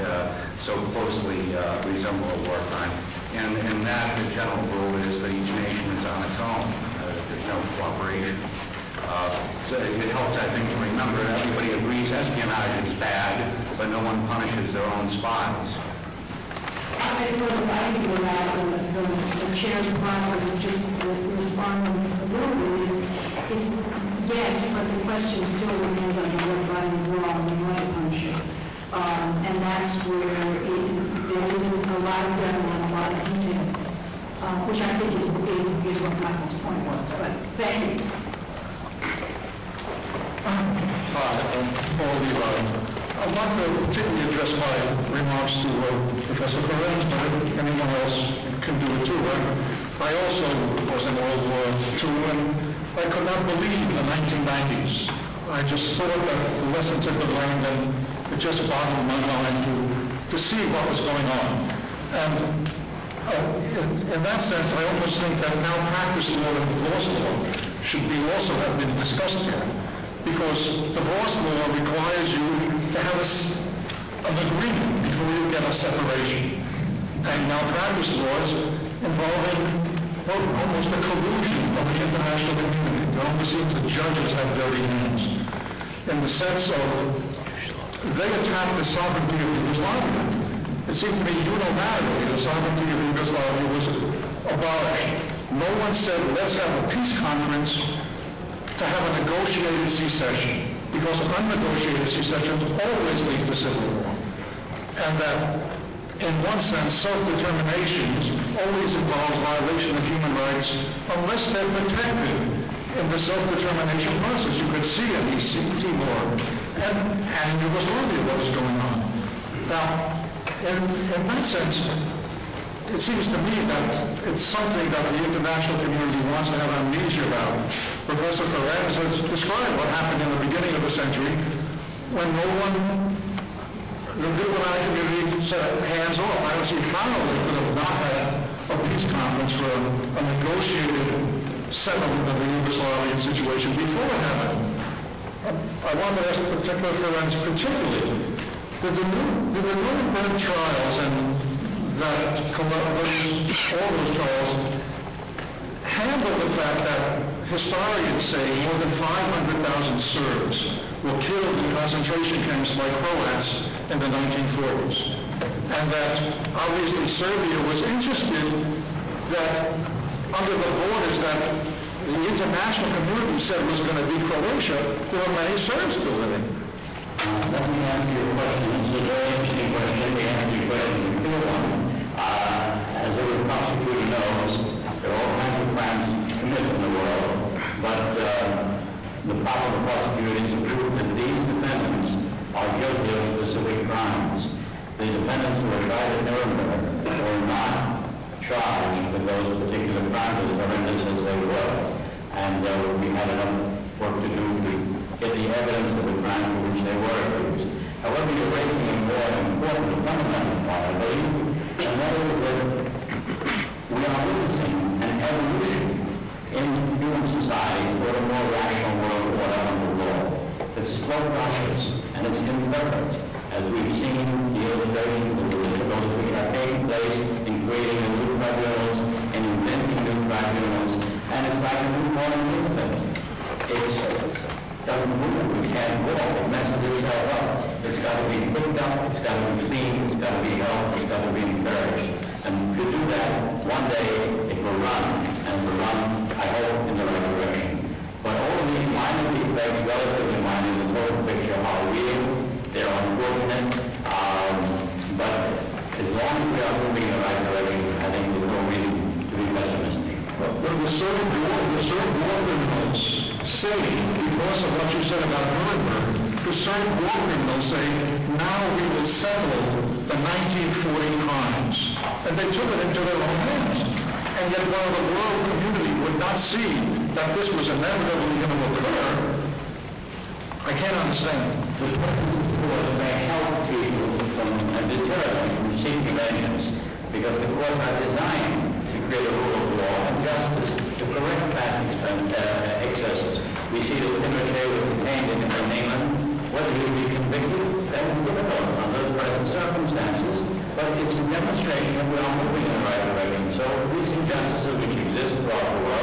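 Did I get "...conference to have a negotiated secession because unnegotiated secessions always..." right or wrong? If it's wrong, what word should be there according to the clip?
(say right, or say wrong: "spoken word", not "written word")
right.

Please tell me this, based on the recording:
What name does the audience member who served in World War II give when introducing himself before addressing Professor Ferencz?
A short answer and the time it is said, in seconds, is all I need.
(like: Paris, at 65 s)
Paul Levi, at 41 s.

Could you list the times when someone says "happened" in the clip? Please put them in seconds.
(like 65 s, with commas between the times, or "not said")
129 s, 144 s.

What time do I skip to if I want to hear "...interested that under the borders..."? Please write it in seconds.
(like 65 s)
167 s.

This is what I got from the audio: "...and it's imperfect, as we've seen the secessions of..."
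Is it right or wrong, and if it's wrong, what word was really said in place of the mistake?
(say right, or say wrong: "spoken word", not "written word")
wrong: "illustrations", not "secessions".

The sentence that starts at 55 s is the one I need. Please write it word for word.
I just thought that the lessons had been learned, and it just boggled my mind to, to see what was going on.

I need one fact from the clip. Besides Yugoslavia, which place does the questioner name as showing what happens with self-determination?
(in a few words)
East Timor.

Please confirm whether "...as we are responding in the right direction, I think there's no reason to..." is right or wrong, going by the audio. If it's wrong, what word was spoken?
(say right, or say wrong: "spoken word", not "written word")
wrong: "moving", not "responding".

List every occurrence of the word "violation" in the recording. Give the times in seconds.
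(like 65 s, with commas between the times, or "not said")
109 s.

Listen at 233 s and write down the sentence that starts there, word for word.
It doesn't move, it can't walk, it messes itself up.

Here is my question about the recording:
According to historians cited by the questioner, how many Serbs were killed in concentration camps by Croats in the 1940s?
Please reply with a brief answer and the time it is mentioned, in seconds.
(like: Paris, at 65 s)
more than 500,000, at 158 s.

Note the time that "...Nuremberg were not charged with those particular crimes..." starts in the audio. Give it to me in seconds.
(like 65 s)
196 s.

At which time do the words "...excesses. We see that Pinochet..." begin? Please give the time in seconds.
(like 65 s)
292 s.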